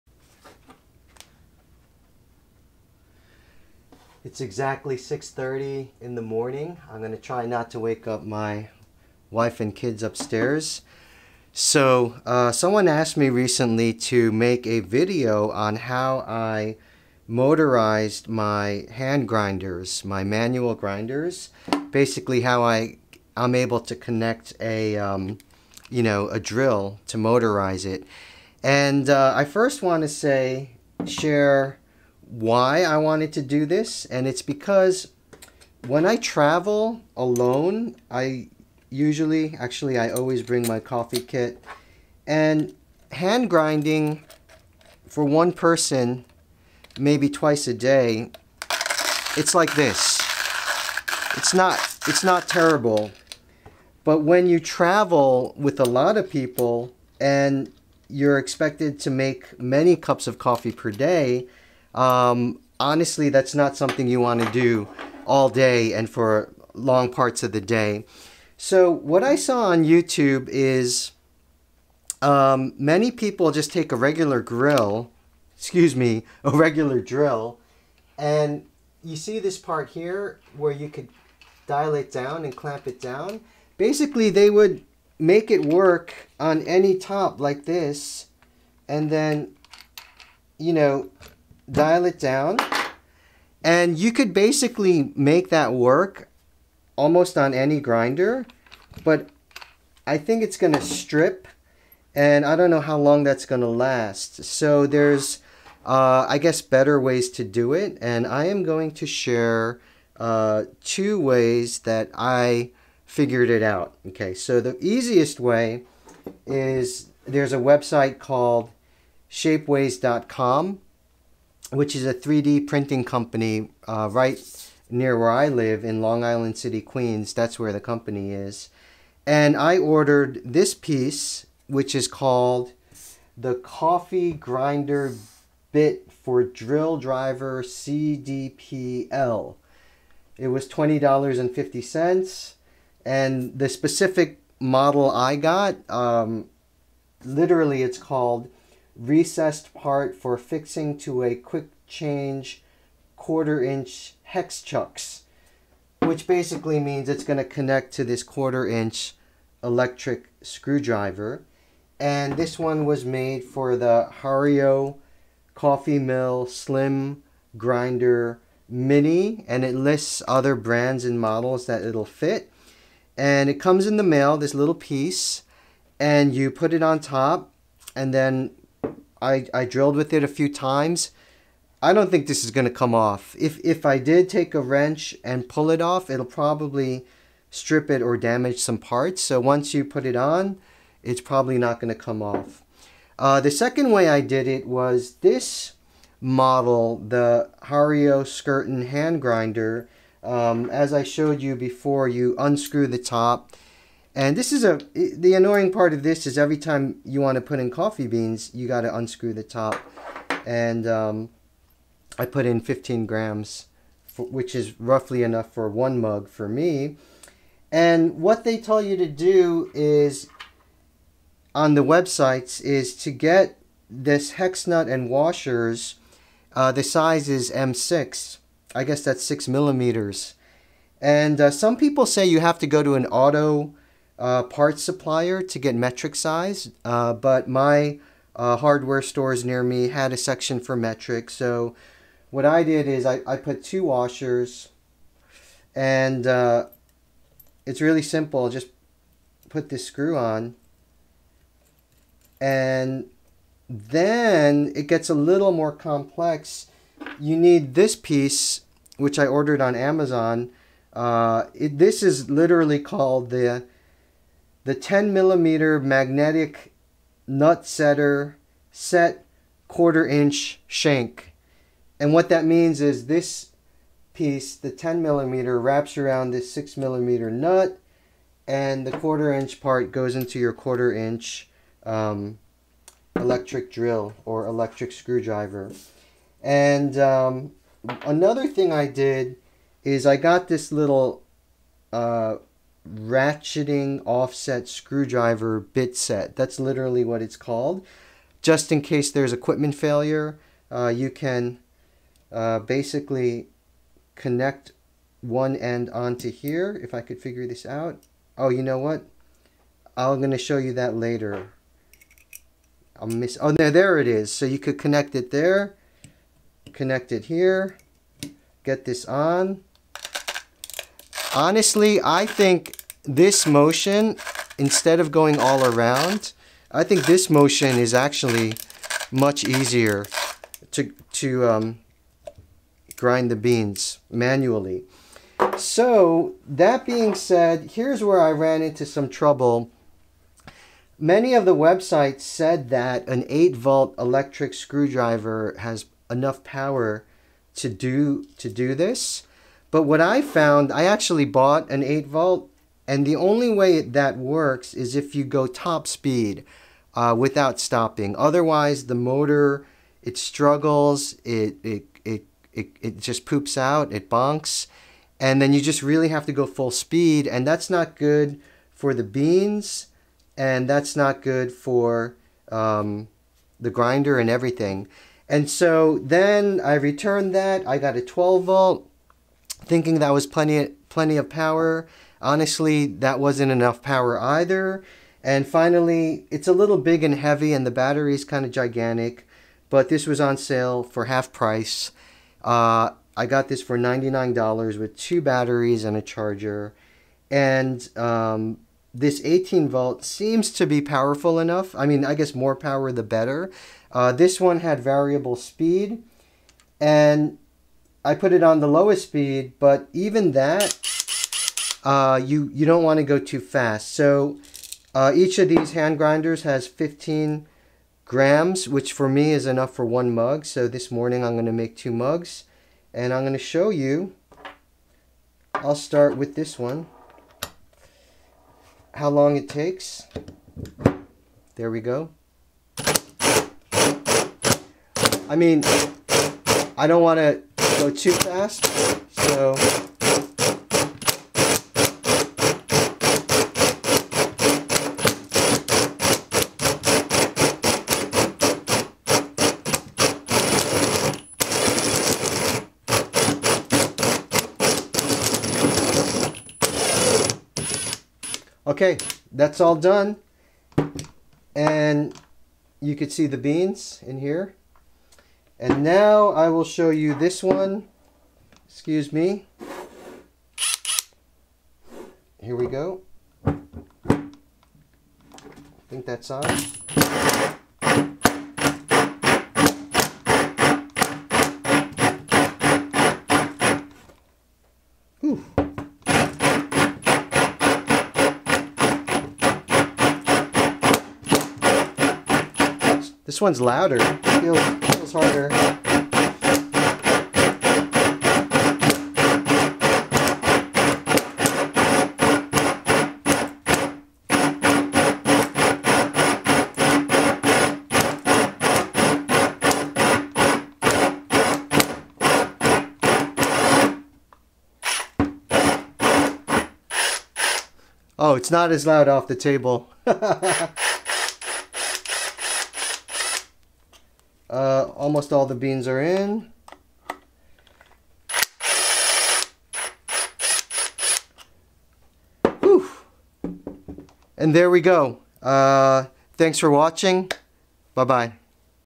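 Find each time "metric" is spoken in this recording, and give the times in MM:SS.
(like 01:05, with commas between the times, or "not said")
03:55, 04:00.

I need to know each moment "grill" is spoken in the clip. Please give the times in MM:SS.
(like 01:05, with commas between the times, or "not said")
01:14.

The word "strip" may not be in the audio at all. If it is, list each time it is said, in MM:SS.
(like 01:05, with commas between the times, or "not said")
01:40, 03:07.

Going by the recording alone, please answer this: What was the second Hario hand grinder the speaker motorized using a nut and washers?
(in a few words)
Skerton.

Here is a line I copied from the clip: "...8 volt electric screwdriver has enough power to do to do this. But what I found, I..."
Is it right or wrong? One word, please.
right.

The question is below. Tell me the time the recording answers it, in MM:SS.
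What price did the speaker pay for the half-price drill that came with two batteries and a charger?
06:33.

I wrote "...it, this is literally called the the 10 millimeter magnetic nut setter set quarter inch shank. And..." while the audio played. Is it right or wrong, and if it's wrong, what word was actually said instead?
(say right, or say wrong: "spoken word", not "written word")
right.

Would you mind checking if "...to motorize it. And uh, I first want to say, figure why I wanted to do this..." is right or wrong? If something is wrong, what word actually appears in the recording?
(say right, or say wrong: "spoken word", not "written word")
wrong: "share", not "figure".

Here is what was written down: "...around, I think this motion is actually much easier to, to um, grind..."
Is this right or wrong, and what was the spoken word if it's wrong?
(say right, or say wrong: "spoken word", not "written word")
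right.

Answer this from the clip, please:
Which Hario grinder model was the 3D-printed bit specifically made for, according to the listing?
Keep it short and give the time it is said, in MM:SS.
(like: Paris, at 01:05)
Coffee Mill Slim Grinder Mini, at 02:45.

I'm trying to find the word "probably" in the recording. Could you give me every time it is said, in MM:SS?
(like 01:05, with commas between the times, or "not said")
03:06, 03:11.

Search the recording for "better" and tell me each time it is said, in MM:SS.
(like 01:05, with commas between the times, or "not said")
01:46, 06:43.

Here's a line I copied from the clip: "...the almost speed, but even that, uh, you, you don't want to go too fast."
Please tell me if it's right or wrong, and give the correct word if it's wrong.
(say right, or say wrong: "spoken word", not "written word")
wrong: "lowest", not "almost".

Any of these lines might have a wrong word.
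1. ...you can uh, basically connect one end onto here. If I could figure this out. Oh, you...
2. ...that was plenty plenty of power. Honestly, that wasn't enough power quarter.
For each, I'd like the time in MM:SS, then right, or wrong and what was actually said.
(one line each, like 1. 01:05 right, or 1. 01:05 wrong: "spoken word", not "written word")
1. 05:00 right
2. 06:19 wrong: "either", not "quarter".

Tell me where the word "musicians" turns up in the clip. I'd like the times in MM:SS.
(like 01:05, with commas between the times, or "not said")
not said.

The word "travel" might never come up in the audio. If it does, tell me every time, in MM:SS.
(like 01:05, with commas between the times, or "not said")
00:36, 00:54.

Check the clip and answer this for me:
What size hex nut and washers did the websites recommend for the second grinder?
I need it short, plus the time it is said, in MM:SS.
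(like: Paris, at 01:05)
M6, at 03:47.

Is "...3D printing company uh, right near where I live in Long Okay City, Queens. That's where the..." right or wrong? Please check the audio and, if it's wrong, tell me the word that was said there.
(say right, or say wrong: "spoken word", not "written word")
wrong: "Island", not "Okay".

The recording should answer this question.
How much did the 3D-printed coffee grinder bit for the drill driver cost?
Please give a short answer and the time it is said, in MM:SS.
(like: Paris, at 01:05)
$20.50, at 02:20.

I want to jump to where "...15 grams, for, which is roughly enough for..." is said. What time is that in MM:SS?
03:32.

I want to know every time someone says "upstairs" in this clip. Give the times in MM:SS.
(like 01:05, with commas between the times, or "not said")
00:10.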